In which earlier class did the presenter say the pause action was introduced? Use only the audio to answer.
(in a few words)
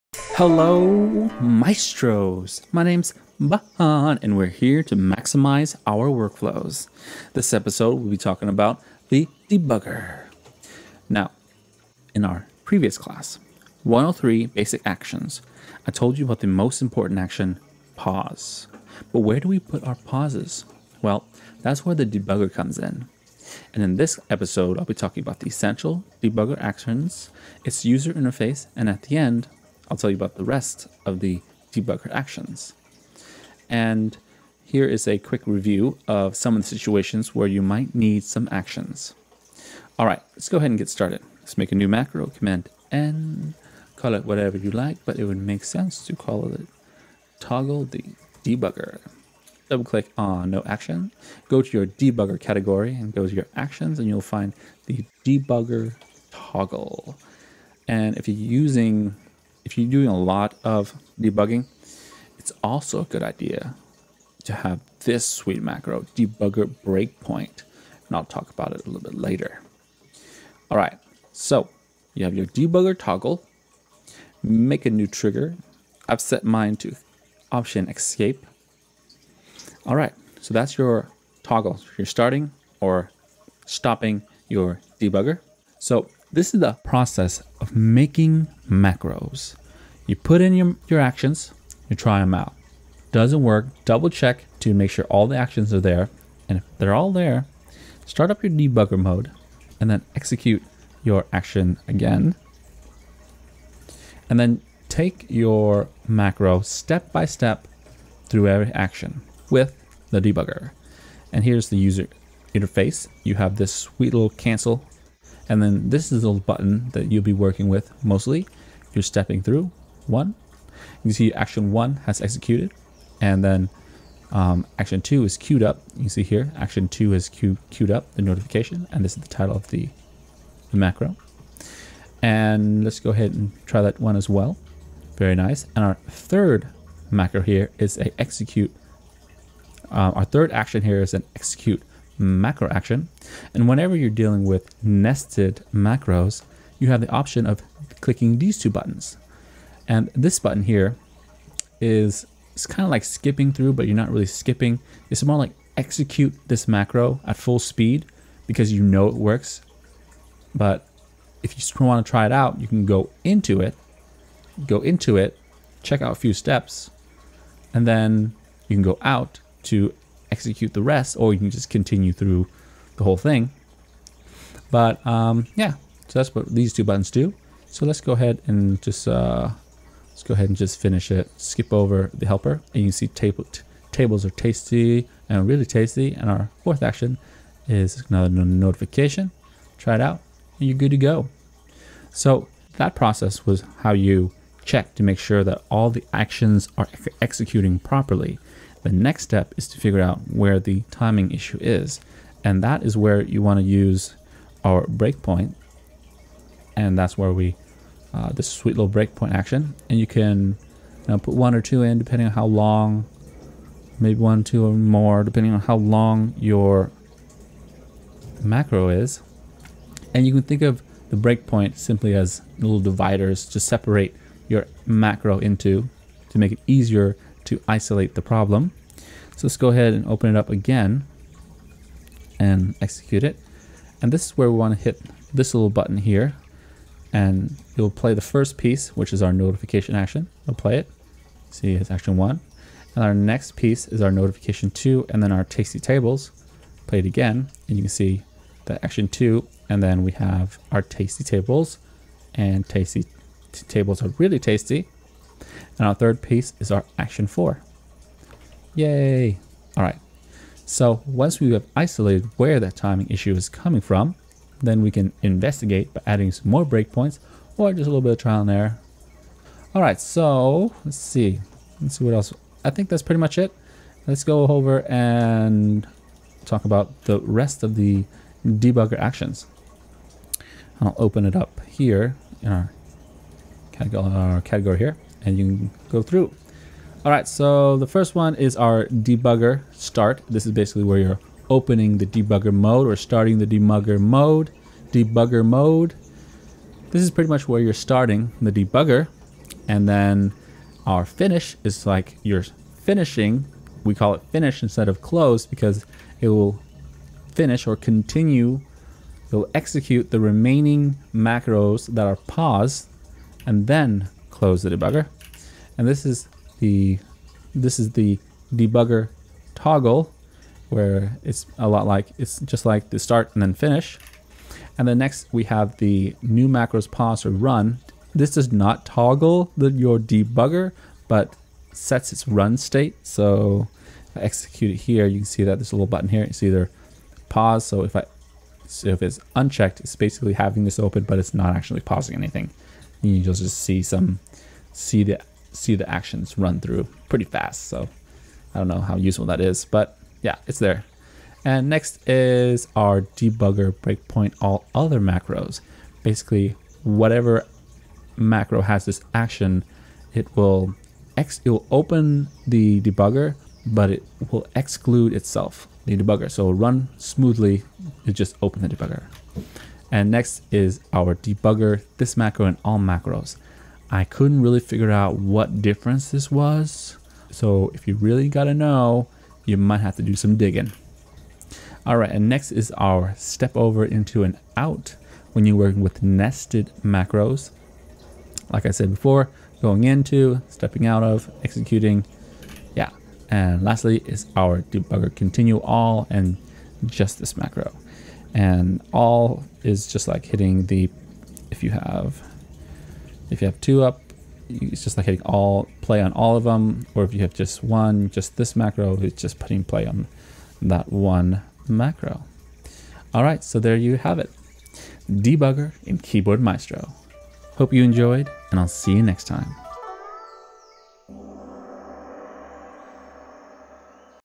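103 basic actions.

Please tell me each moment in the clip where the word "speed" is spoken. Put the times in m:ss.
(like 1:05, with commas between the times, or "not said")
2:37.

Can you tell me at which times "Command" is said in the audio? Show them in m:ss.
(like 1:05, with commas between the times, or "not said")
0:42.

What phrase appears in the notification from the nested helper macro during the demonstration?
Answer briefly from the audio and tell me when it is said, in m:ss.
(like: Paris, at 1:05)
Tables are tasty, at 3:03.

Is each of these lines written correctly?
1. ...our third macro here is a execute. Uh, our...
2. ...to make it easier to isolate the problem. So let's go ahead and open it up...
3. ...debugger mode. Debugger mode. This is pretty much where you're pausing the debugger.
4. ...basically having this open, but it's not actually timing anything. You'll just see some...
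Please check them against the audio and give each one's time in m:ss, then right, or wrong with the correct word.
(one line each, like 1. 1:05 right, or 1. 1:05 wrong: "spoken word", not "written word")
1. 2:15 right
2. 3:46 right
3. 4:53 wrong: "starting", not "pausing"
4. 5:39 wrong: "pausing", not "timing".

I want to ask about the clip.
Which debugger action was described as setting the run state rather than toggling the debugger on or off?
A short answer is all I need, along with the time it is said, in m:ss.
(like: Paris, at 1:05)
New macros pause or run, at 5:26.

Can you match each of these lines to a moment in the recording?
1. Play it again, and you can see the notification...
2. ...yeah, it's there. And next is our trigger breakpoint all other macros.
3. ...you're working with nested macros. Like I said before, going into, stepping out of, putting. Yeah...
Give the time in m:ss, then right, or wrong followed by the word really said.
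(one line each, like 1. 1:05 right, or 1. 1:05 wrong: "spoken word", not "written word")
1. 4:06 wrong: "action", not "notification"
2. 5:50 wrong: "debugger", not "trigger"
3. 6:25 wrong: "executing", not "putting".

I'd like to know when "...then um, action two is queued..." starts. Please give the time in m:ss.
2:03.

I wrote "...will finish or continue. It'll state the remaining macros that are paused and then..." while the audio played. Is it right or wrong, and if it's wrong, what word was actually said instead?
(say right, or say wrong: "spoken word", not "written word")
wrong: "execute", not "state".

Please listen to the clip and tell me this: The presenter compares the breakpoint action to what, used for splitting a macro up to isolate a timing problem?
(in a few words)
Little dividers.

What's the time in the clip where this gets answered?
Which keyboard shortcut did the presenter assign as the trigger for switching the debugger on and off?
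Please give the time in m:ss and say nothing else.
1:17.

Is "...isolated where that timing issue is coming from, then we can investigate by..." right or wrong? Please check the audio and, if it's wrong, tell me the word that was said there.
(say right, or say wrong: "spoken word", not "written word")
right.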